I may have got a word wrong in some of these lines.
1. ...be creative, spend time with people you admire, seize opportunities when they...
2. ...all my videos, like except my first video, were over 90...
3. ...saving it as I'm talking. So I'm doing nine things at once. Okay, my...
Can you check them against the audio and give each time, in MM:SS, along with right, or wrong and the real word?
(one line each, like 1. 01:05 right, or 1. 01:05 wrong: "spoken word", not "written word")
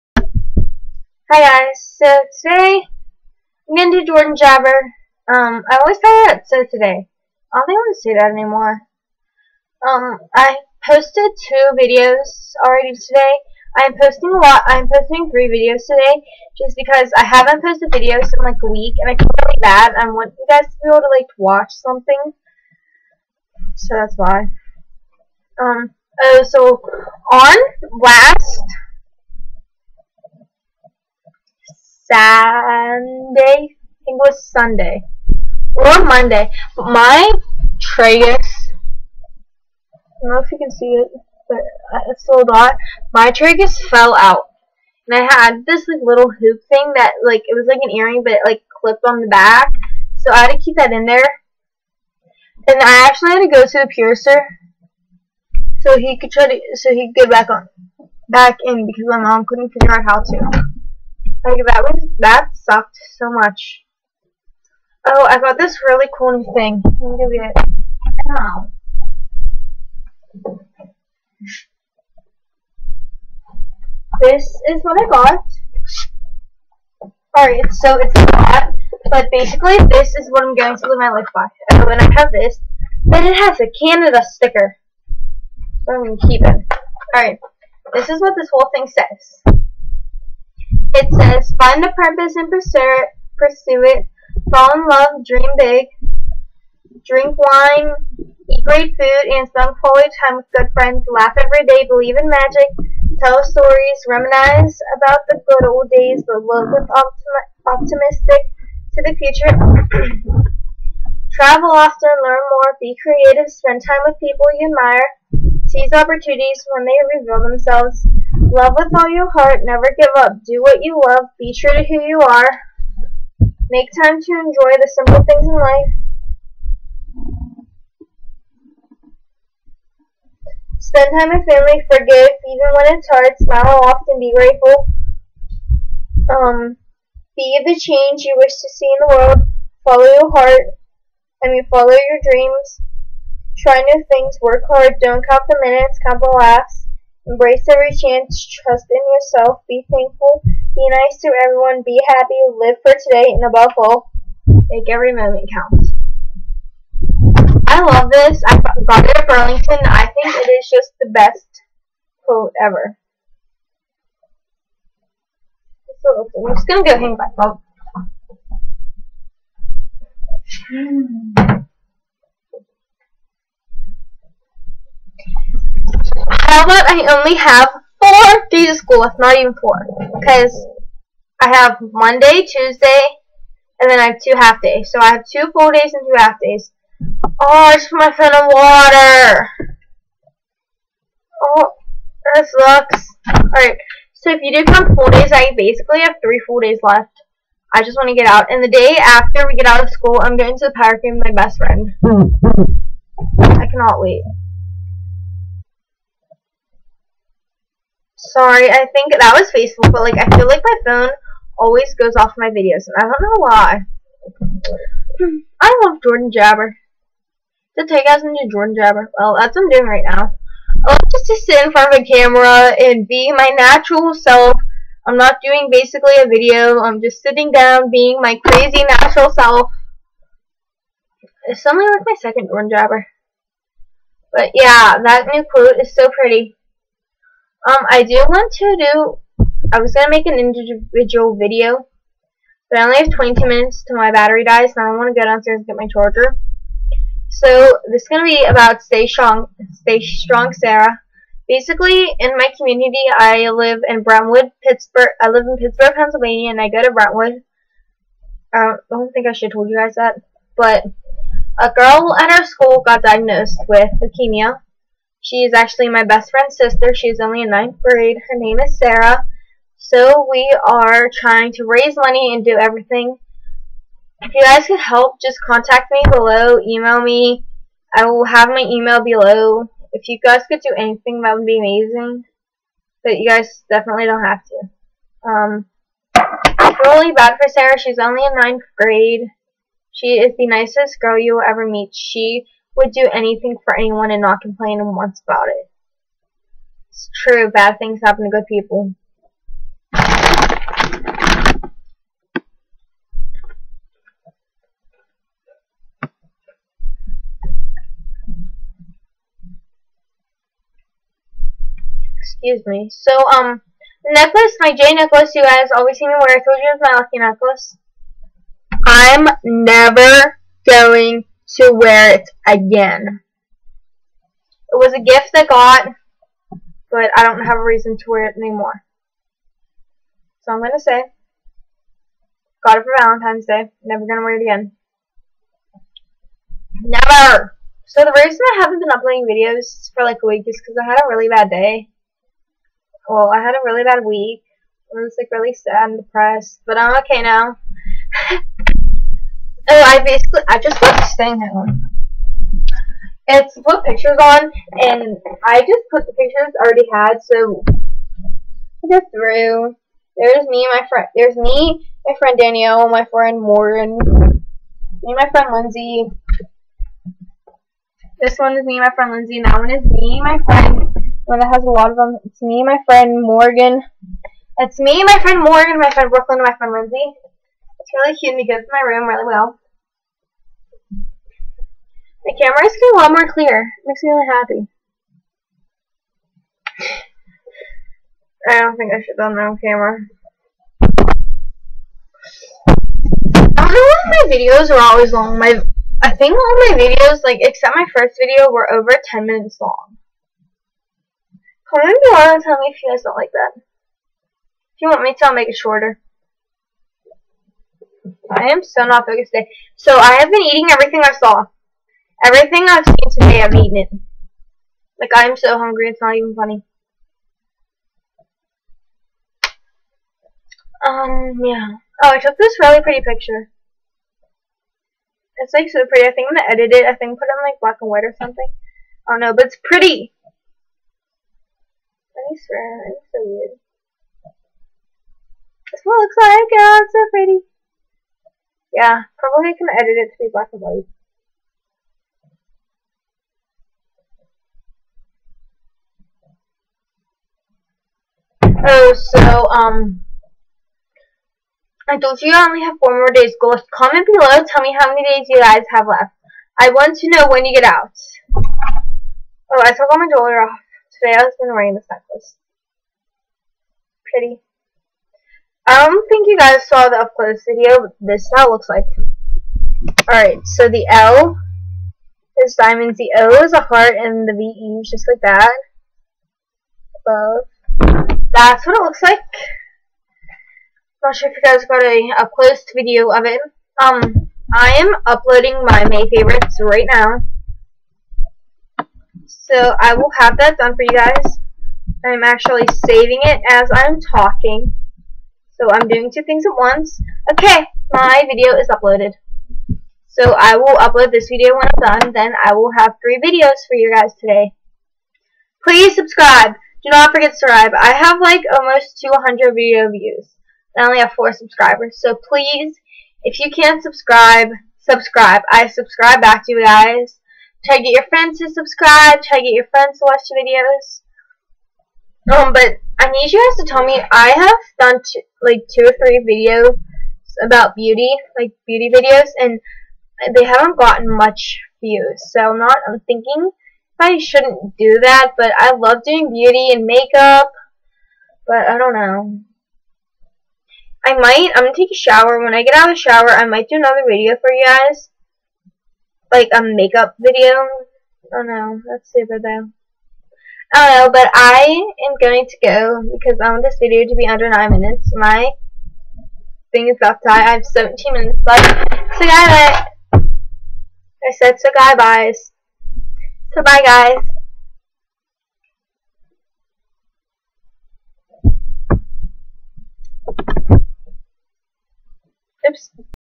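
1. 01:52 right
2. 06:36 wrong: "10", not "90"
3. 08:12 wrong: "two", not "nine".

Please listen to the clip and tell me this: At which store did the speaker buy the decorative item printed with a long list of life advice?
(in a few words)
Burlington.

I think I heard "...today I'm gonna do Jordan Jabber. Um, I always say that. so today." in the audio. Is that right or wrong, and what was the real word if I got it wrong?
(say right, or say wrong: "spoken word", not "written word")
right.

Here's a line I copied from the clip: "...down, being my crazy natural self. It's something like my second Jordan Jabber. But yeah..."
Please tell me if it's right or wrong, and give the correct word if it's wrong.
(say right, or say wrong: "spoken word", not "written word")
right.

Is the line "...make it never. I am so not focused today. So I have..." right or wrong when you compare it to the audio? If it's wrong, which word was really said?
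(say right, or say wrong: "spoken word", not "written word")
wrong: "shorter", not "never".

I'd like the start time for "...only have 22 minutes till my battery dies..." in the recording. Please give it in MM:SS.
04:02.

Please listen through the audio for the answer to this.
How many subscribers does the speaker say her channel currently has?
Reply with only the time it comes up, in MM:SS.
08:31.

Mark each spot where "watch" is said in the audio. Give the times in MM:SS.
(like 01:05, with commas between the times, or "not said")
00:21, 08:40.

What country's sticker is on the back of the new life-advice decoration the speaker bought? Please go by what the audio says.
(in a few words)
Canada.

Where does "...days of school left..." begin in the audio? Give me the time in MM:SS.
02:58.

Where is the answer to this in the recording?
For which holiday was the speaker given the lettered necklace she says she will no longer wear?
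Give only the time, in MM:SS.
05:33.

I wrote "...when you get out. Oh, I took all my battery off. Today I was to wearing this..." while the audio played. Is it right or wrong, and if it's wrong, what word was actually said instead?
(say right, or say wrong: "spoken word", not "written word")
wrong: "jewelry", not "battery".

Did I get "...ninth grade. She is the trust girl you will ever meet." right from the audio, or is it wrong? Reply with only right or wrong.
wrong.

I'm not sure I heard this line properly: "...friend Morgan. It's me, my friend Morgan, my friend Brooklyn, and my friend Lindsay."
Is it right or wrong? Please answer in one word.
right.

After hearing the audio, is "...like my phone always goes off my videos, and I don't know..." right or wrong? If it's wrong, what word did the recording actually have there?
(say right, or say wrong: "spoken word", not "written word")
right.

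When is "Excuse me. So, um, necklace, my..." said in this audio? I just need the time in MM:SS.
05:12.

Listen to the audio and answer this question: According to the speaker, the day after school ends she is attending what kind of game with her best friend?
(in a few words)
Power game.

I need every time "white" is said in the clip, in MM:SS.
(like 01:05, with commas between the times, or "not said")
07:07, 07:20.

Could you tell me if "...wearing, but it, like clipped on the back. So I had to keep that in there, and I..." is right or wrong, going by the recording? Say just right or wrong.
wrong.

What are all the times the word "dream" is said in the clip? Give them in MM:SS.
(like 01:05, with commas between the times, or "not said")
01:35, 02:22.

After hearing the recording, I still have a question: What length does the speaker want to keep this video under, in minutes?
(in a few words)
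9 minutes.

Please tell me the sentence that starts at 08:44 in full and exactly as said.
I have done like two or three videos about beauty, like beauty videos, and they haven't gotten much views.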